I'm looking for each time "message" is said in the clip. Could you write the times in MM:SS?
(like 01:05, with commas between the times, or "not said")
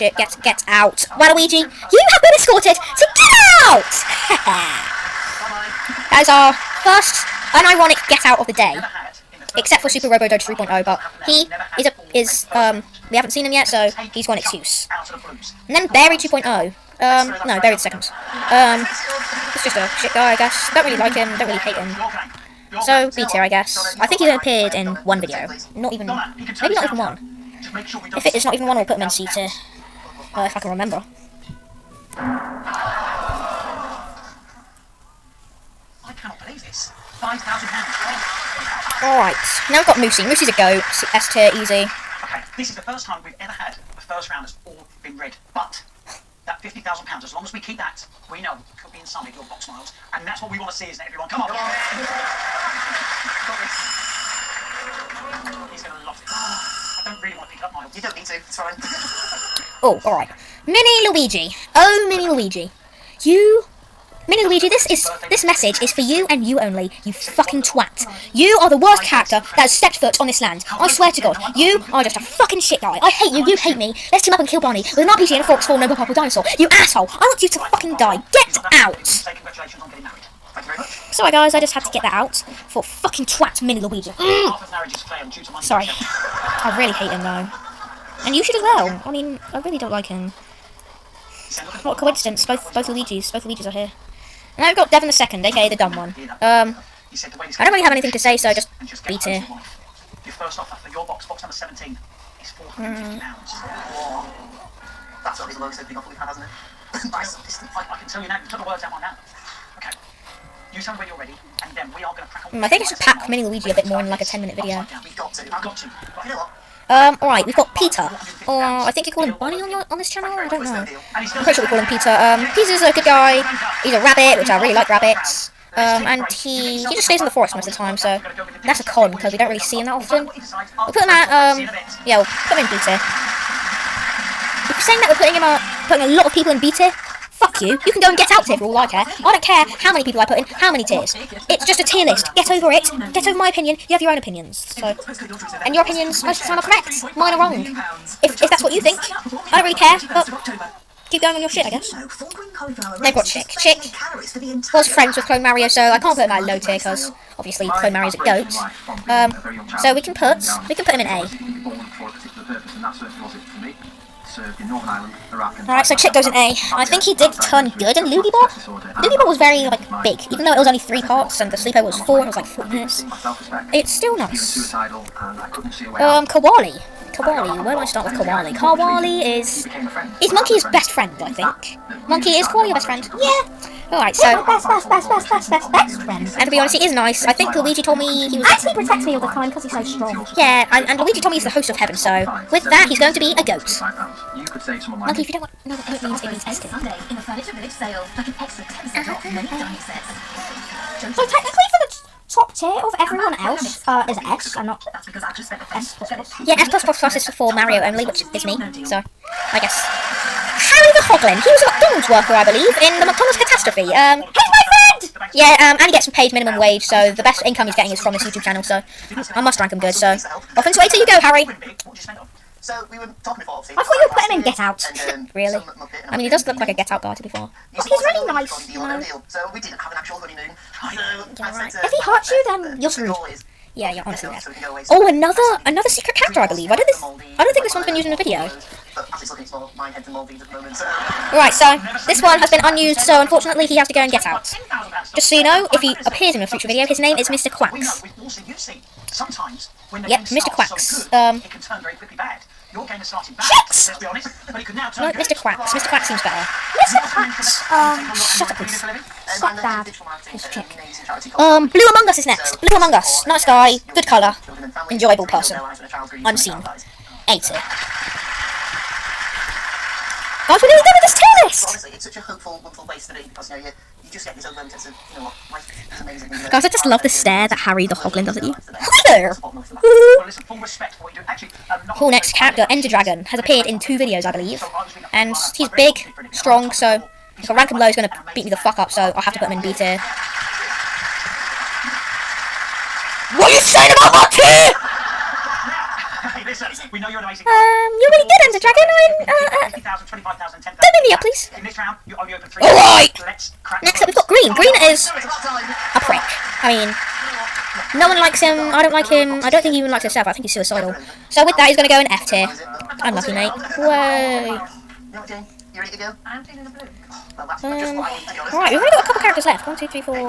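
01:05.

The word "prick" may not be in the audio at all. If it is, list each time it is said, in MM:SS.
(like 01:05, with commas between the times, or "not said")
05:05.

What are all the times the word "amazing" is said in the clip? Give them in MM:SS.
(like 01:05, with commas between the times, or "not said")
04:36, 04:57.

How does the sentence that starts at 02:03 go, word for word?
He's a rabbit, which I really like rabbits.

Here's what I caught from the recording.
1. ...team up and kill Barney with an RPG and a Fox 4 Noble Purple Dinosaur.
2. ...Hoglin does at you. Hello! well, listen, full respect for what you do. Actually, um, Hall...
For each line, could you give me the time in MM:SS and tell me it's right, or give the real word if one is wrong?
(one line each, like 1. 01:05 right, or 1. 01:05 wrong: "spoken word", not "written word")
1. 01:14 right
2. 04:37 right.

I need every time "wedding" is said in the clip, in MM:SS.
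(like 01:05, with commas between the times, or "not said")
not said.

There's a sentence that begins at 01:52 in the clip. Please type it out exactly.
Mm, I think I should pack Mini Luigi a bit more in like a 10 minute video.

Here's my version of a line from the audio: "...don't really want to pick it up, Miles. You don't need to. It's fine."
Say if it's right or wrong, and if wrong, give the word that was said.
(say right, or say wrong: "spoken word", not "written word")
right.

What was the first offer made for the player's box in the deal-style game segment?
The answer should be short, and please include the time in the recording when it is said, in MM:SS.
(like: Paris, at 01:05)
£450, at 01:42.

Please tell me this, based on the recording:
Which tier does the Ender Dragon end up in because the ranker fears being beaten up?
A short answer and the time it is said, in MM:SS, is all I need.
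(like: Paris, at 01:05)
B tier, at 04:49.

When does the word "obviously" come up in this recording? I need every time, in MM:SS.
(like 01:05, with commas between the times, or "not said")
02:37, 03:43.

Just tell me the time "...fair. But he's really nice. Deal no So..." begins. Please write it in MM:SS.
03:47.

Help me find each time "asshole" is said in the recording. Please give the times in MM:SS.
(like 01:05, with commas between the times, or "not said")
01:16.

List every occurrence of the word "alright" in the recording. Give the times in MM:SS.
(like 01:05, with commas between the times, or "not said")
00:39, 01:00, 01:57, 02:45, 03:03.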